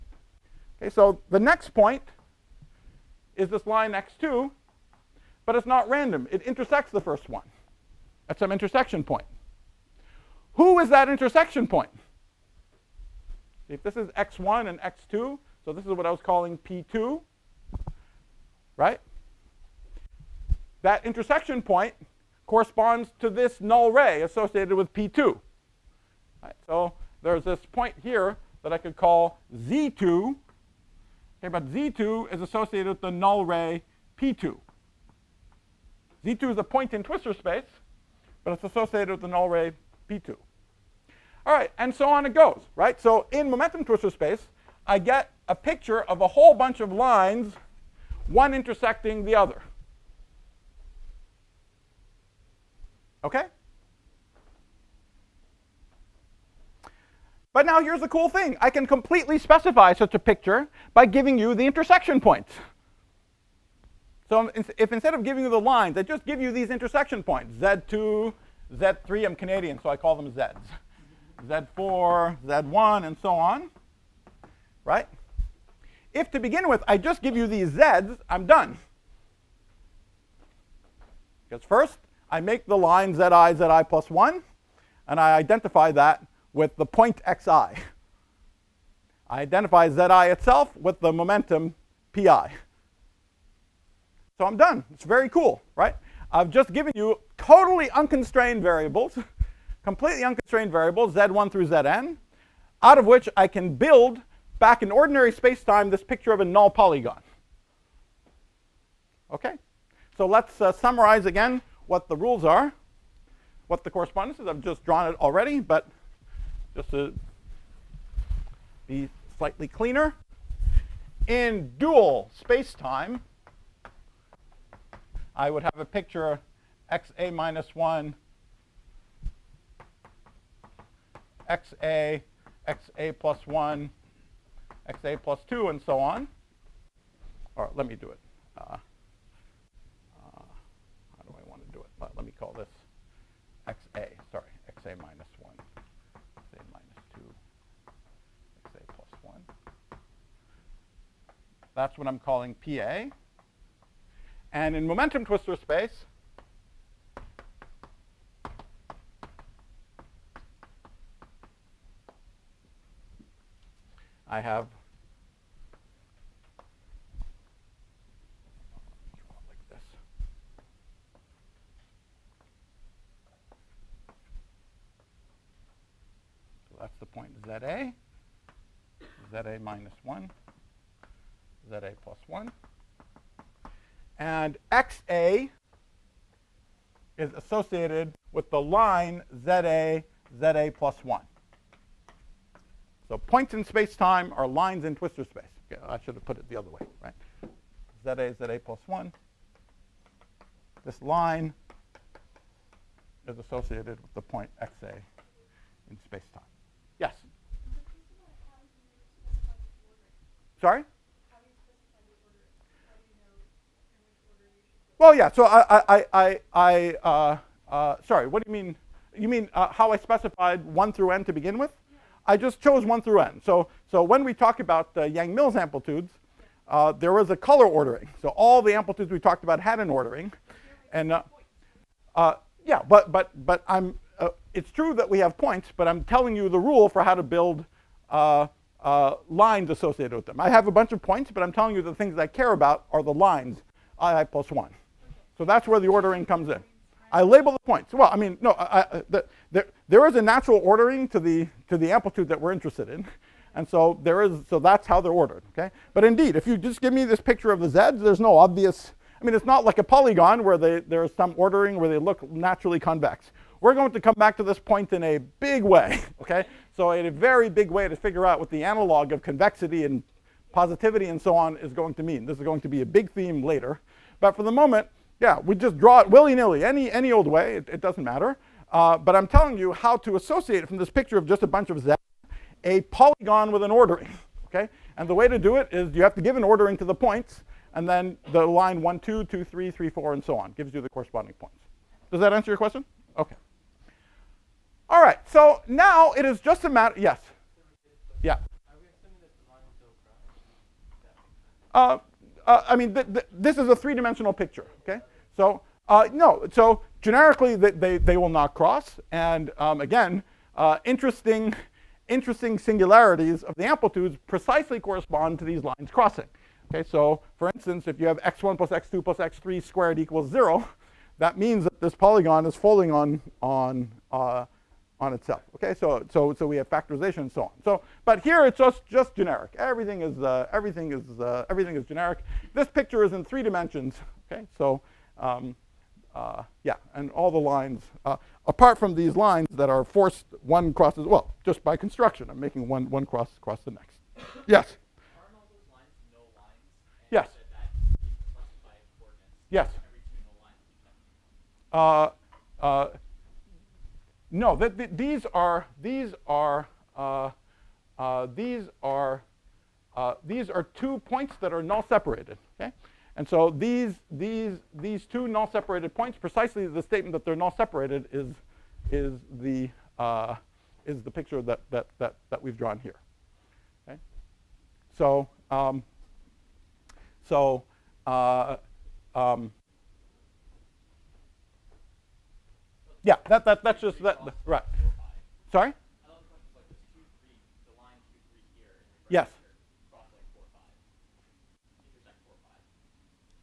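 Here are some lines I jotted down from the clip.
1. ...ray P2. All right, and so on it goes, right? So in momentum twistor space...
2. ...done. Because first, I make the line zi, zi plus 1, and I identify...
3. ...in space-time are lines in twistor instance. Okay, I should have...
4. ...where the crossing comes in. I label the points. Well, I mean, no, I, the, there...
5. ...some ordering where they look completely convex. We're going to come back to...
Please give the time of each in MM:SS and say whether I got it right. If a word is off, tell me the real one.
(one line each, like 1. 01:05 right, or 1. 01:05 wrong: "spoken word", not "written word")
1. 00:39 right
2. 01:18 right
3. 03:13 wrong: "space", not "instance"
4. 04:05 wrong: "ordering", not "crossing"
5. 04:21 wrong: "naturally", not "completely".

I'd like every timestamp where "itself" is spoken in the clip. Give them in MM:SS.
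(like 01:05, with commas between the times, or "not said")
01:30, 05:25.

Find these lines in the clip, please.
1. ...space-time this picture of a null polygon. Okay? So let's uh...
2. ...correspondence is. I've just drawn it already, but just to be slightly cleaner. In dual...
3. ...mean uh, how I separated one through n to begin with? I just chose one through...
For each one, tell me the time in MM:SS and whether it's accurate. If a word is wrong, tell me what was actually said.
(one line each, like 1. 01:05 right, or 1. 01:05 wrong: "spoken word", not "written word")
1. 01:45 right
2. 01:53 right
3. 03:39 wrong: "specified", not "separated".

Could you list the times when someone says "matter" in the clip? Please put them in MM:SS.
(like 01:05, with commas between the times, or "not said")
04:38, 04:56.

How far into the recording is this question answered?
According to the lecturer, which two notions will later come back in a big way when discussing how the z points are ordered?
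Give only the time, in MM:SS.
04:29.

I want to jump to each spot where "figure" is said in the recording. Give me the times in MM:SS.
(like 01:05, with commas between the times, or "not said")
04:27.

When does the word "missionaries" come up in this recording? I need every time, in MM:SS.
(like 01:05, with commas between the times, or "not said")
not said.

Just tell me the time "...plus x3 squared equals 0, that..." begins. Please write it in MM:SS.
05:19.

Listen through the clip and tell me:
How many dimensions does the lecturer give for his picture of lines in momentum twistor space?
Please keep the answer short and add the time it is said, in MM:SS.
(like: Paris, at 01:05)
3, at 05:03.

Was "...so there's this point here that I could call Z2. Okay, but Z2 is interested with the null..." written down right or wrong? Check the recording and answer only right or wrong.
wrong.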